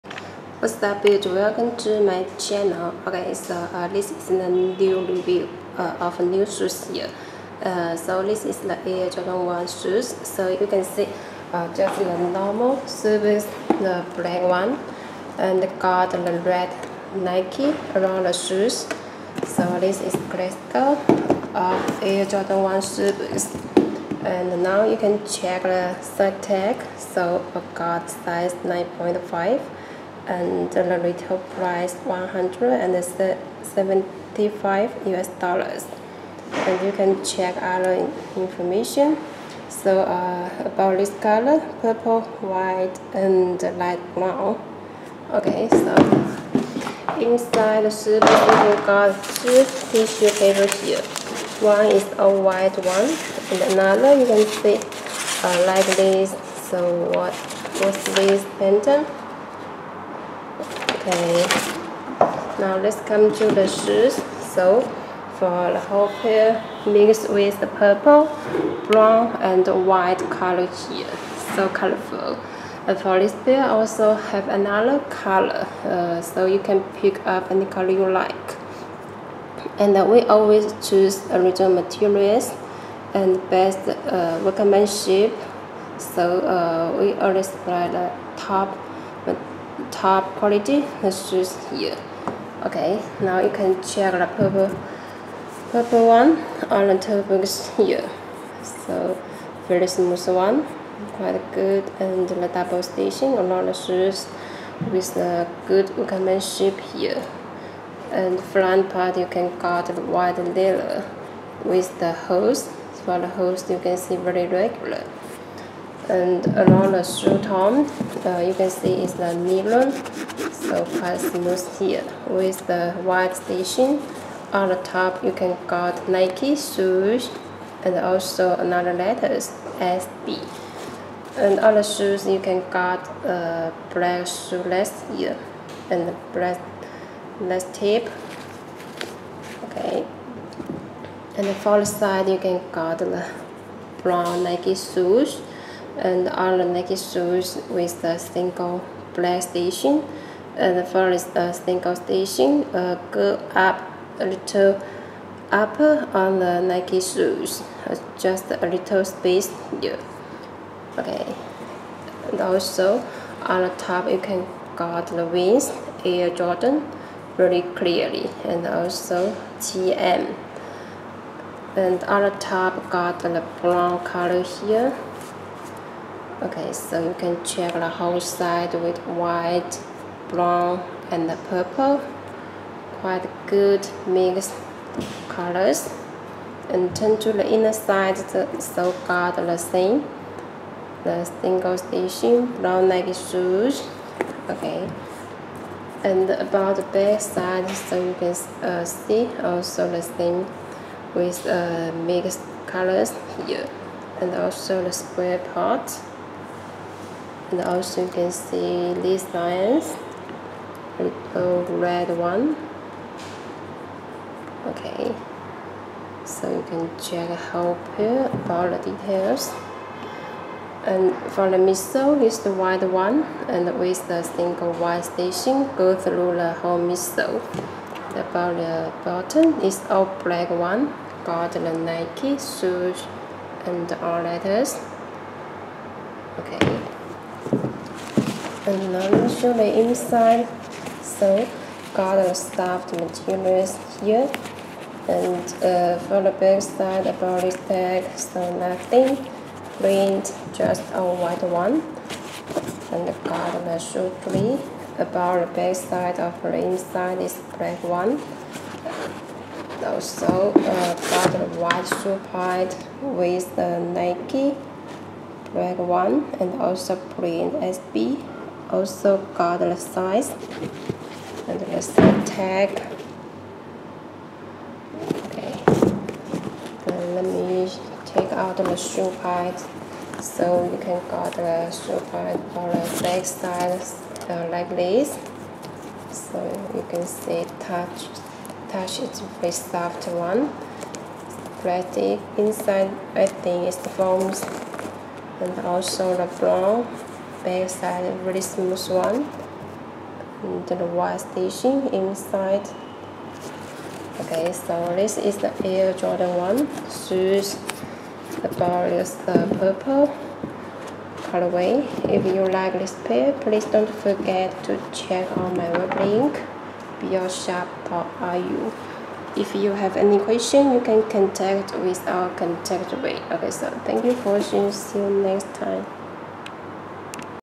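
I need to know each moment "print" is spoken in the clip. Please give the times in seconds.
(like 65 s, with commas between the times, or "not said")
249 s, 267 s.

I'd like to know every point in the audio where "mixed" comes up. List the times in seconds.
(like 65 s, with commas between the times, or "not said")
66 s, 184 s, 202 s.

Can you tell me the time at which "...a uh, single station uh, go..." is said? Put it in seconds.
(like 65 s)
151 s.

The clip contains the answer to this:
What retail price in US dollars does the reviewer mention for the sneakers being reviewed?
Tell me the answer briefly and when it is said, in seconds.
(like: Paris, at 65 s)
$175, at 32 s.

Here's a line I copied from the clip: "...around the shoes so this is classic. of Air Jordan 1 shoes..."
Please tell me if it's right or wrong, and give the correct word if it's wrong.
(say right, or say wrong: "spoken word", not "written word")
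right.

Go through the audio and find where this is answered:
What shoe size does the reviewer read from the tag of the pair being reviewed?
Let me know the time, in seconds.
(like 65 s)
28 s.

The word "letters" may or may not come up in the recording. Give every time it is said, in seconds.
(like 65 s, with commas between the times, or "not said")
128 s, 234 s.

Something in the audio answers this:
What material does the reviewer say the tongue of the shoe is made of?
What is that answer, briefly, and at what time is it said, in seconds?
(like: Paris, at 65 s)
Nylon, at 119 s.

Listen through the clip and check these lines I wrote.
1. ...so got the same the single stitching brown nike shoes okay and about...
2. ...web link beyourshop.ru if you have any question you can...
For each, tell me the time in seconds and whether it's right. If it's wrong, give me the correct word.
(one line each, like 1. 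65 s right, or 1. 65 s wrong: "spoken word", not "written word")
1. 188 s right
2. 315 s right.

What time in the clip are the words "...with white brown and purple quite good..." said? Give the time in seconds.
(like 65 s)
178 s.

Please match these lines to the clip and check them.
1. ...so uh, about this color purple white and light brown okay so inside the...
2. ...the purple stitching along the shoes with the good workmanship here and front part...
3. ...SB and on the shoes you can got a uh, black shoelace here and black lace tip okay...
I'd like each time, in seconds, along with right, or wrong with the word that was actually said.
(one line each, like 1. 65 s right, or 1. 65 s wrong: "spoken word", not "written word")
1. 39 s right
2. 102 s wrong: "double", not "purple"
3. 129 s right.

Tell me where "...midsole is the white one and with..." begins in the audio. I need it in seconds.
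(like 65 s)
221 s.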